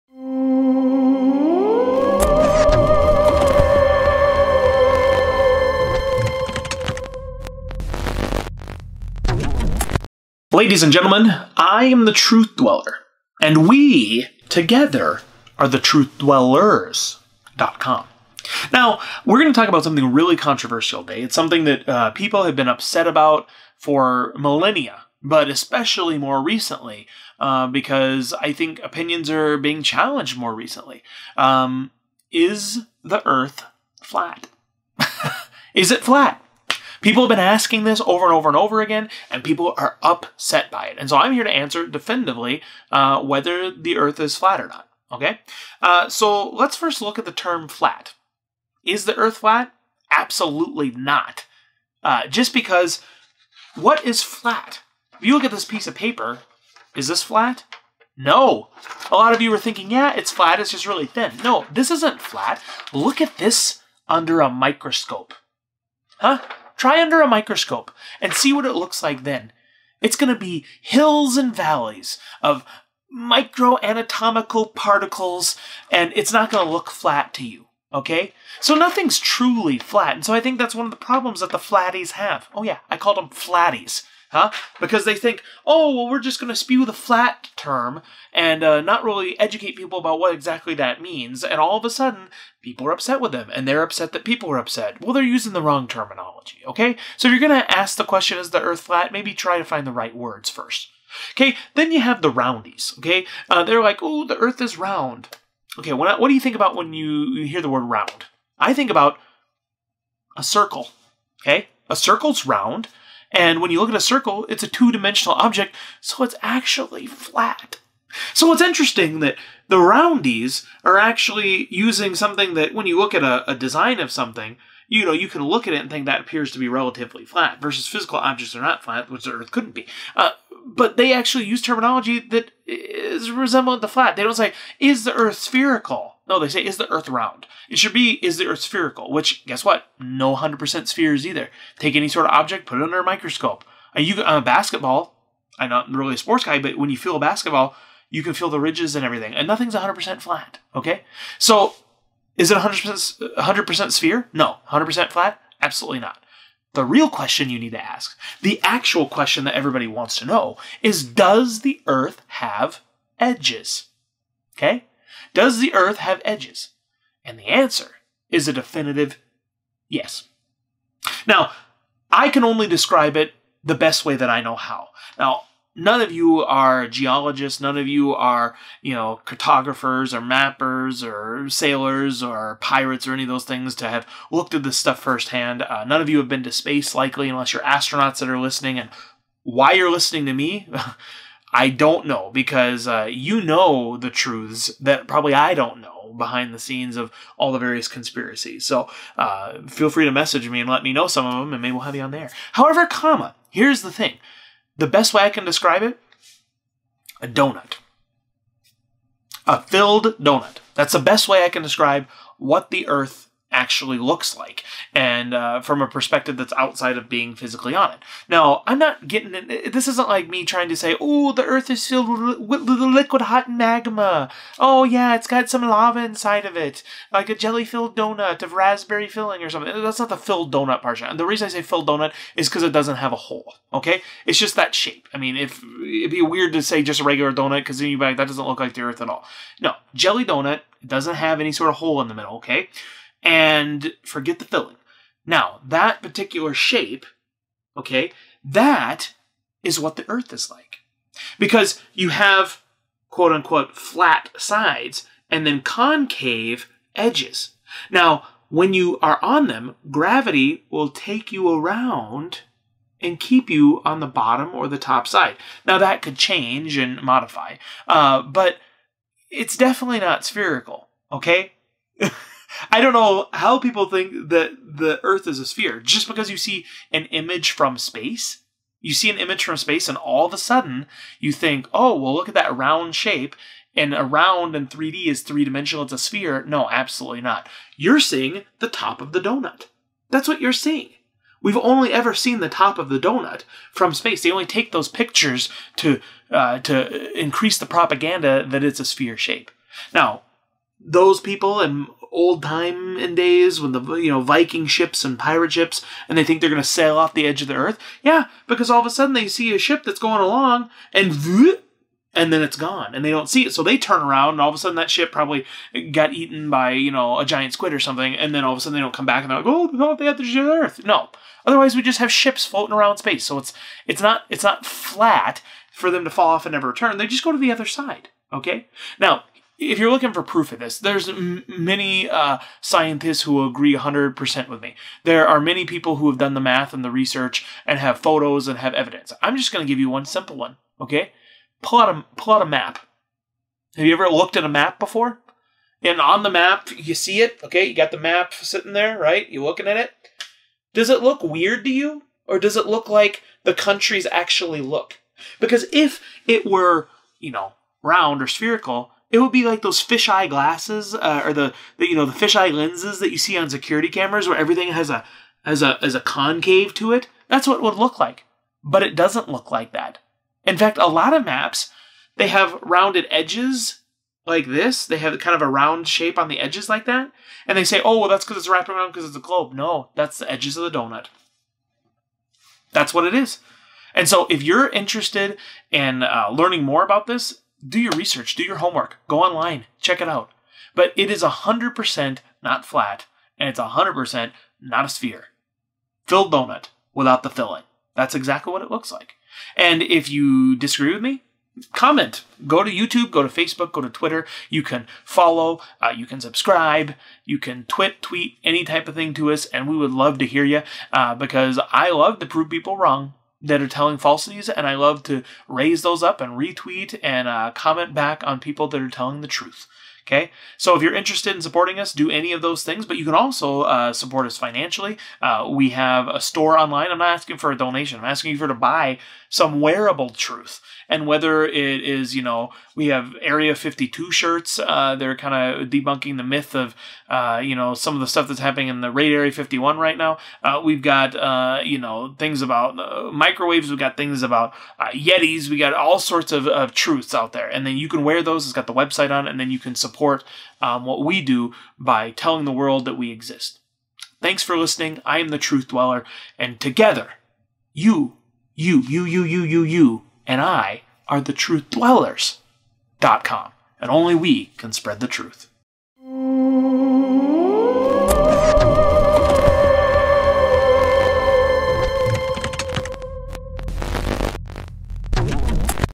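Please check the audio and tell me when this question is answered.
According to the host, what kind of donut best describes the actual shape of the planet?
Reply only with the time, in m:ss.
3:29.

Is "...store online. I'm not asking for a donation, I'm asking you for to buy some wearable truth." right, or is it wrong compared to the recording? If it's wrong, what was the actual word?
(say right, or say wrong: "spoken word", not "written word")
right.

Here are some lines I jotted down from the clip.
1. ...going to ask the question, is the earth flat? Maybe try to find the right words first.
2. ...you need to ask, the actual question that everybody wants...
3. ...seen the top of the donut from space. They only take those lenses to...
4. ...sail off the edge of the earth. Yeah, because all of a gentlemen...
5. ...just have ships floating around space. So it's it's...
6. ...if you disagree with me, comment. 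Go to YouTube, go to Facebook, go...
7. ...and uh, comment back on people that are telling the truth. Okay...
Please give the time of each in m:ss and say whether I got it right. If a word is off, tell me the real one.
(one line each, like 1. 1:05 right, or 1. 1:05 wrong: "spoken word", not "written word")
1. 1:37 right
2. 2:37 right
3. 4:52 wrong: "pictures", not "lenses"
4. 5:06 wrong: "sudden", not "gentlemen"
5. 5:21 right
6. 6:39 right
7. 6:57 right.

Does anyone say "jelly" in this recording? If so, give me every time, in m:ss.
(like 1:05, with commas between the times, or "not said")
3:47, 3:59.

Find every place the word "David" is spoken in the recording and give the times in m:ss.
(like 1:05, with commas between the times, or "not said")
not said.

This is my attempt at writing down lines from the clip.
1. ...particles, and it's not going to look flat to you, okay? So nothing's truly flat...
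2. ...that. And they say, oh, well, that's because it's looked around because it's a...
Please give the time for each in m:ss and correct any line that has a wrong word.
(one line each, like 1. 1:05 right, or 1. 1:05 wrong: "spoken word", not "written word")
1. 1:14 right
2. 6:16 wrong: "wrapped", not "looked".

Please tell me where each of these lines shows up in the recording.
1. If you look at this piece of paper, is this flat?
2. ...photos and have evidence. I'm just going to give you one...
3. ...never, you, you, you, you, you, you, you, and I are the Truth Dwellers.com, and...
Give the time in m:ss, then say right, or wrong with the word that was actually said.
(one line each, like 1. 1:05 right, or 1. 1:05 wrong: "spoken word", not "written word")
1. 0:55 right
2. 5:37 right
3. 7:36 wrong: "together", not "never".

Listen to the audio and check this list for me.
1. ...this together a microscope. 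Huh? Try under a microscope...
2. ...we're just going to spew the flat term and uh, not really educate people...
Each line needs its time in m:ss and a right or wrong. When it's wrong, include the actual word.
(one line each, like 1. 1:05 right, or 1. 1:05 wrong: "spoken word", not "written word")
1. 1:03 wrong: "under", not "together"
2. 1:26 right.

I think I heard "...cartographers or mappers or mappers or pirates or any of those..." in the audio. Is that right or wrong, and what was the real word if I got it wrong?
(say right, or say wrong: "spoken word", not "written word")
wrong: "sailors", not "mappers".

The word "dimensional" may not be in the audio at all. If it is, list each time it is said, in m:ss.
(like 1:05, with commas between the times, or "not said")
1:54, 4:45.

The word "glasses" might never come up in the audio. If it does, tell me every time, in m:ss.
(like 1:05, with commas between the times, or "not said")
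6:00.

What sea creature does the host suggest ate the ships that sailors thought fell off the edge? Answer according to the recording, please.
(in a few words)
giant squid.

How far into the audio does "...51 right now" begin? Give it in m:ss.
7:19.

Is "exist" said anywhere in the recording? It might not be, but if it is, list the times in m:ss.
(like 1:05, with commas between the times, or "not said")
7:33.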